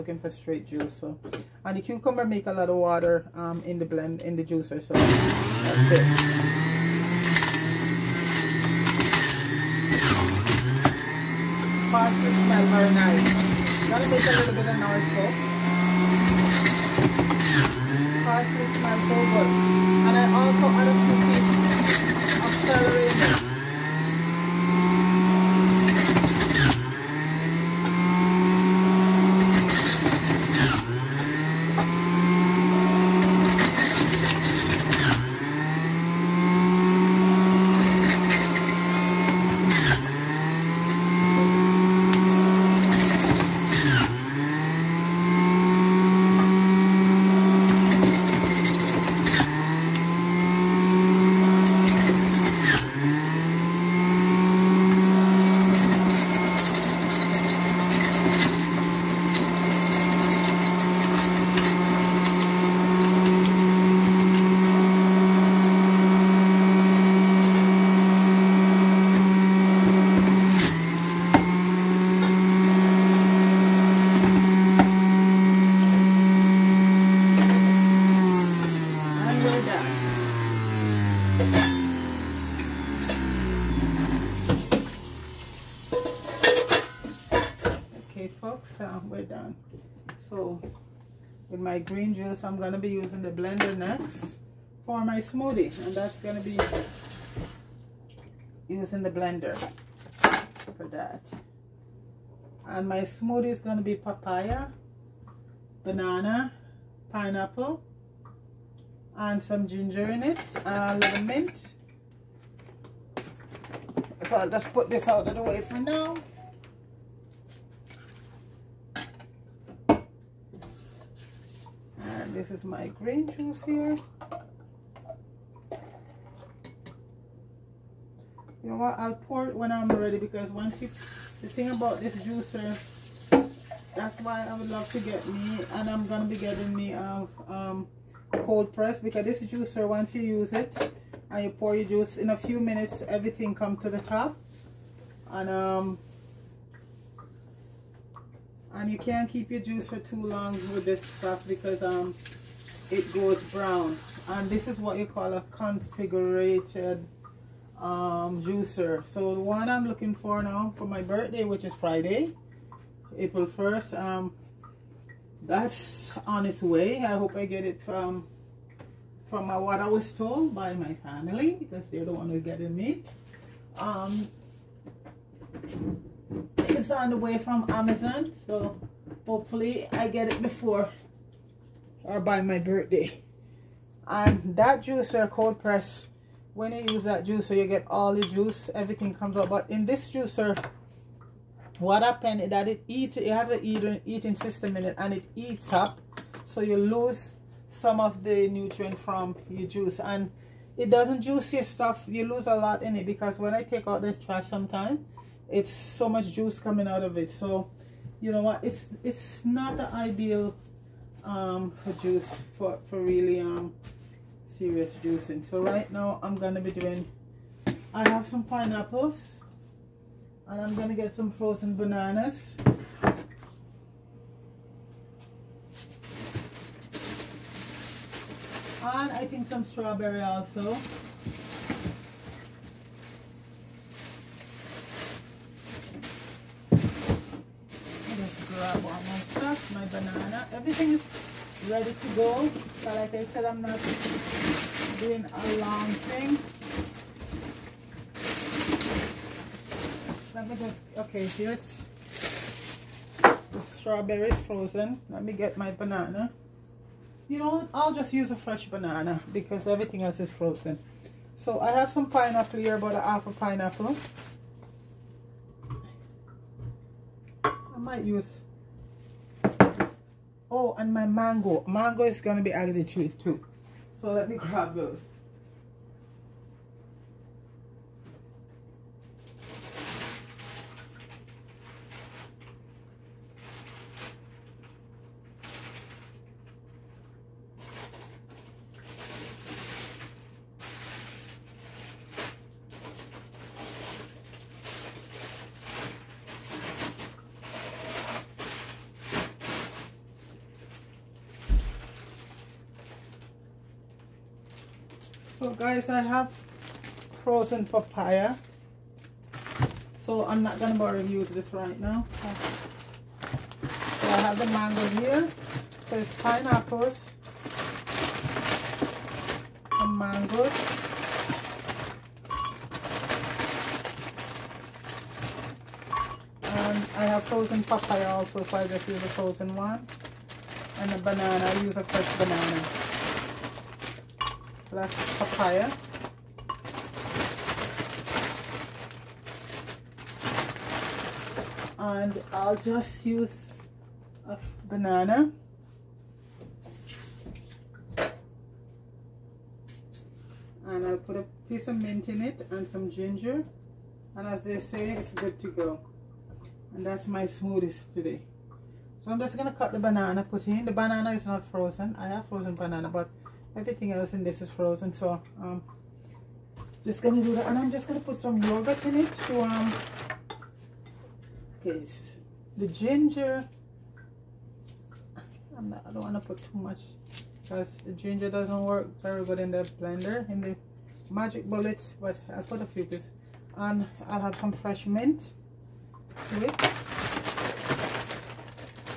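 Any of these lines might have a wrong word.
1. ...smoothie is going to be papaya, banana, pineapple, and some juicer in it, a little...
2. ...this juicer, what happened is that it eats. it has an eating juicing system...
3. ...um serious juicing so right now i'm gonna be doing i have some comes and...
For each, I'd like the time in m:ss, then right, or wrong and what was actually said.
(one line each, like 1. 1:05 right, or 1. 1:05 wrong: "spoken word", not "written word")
1. 1:43 wrong: "ginger", not "juicer"
2. 3:09 wrong: "eating", not "juicing"
3. 3:33 wrong: "pineapples", not "comes".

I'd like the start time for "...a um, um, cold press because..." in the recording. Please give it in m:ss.
2:16.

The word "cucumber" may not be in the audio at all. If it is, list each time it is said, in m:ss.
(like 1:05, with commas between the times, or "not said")
0:01.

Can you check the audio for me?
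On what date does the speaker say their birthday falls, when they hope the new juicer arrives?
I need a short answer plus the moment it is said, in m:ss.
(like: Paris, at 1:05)
April 1st, at 2:43.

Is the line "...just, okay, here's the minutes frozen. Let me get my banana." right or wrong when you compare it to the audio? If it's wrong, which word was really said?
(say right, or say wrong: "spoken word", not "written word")
wrong: "strawberries", not "minutes".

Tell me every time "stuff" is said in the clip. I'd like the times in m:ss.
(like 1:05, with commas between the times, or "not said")
2:31, 3:21.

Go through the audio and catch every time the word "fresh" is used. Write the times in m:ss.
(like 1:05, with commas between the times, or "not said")
4:18, 5:31, 6:24.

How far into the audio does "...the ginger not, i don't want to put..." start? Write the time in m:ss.
6:12.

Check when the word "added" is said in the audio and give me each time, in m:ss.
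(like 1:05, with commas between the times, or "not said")
4:32.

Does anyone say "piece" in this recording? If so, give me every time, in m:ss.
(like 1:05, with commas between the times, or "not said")
5:51, 6:22.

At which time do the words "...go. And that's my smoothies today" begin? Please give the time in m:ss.
5:55.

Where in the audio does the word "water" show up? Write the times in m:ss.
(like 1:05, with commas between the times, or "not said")
0:02.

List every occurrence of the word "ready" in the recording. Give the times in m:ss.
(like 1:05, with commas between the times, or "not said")
2:09, 4:01.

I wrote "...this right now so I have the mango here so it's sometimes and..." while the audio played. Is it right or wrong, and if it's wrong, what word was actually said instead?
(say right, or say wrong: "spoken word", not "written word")
wrong: "pineapples", not "sometimes".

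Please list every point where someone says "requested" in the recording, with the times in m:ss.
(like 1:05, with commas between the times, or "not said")
not said.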